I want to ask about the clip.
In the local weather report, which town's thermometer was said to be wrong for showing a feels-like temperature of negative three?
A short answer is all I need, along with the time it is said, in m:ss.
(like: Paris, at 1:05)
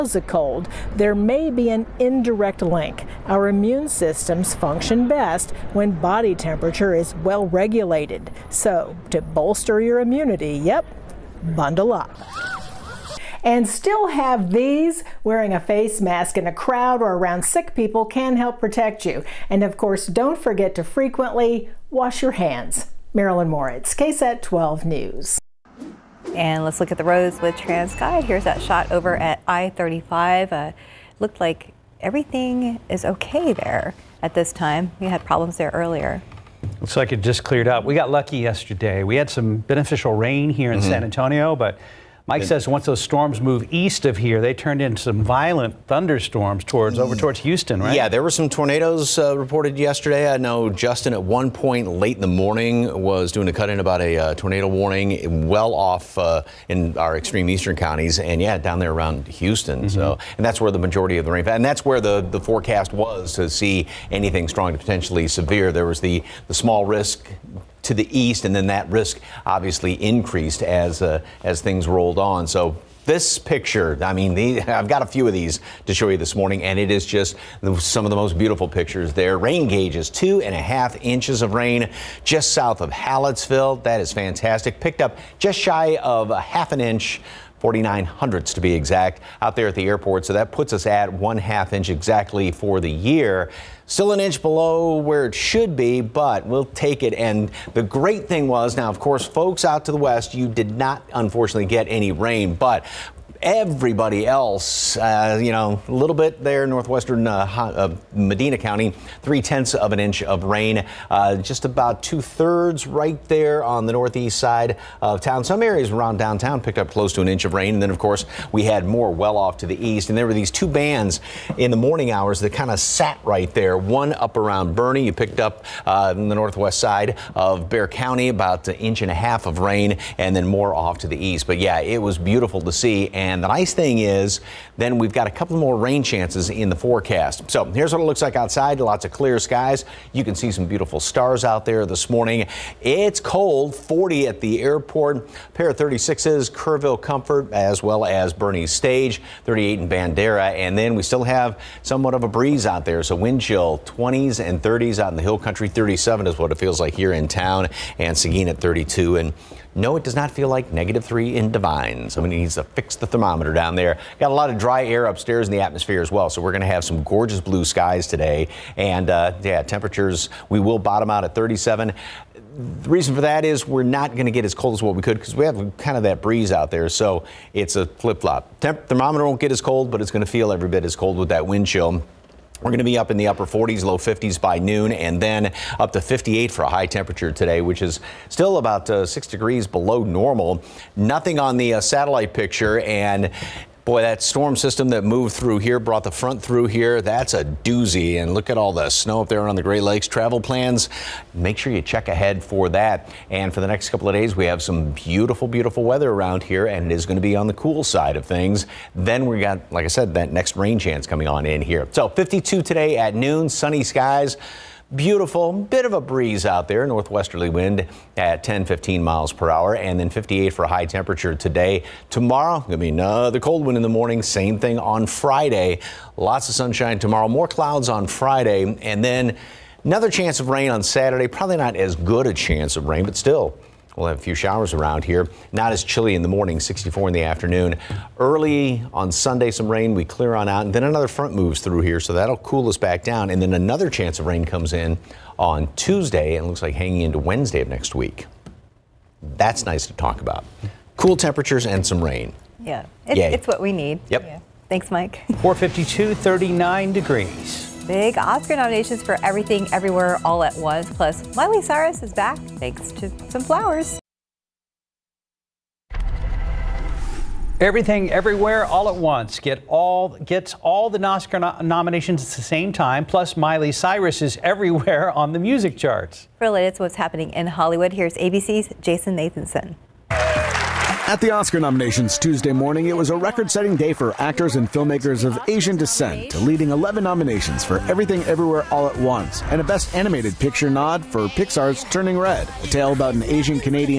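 Devine, at 2:41.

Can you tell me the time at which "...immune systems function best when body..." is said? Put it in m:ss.
0:03.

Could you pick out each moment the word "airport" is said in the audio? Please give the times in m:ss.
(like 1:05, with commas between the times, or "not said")
1:29, 2:24.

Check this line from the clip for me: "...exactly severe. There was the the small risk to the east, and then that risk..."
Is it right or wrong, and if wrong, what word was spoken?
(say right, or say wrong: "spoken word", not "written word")
wrong: "potentially", not "exactly".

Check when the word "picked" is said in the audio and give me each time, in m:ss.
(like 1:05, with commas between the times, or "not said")
1:24, 1:56, 2:05.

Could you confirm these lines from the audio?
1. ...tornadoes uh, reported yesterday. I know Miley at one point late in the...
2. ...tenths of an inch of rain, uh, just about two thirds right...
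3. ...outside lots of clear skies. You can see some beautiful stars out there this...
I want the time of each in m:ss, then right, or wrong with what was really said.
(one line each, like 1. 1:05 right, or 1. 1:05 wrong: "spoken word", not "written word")
1. 0:48 wrong: "Justin", not "Miley"
2. 1:49 right
3. 2:18 right.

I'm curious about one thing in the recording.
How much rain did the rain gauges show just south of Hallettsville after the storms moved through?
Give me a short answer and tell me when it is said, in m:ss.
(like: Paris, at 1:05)
2.5 inches, at 1:20.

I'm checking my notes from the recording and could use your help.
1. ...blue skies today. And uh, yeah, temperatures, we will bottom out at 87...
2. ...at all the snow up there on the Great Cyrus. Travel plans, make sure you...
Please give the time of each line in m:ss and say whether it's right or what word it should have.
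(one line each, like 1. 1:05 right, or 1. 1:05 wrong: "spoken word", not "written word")
1. 2:47 wrong: "37", not "87"
2. 3:18 wrong: "Lakes", not "Cyrus".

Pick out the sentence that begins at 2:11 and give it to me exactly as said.
But yeah, it was beautiful to see.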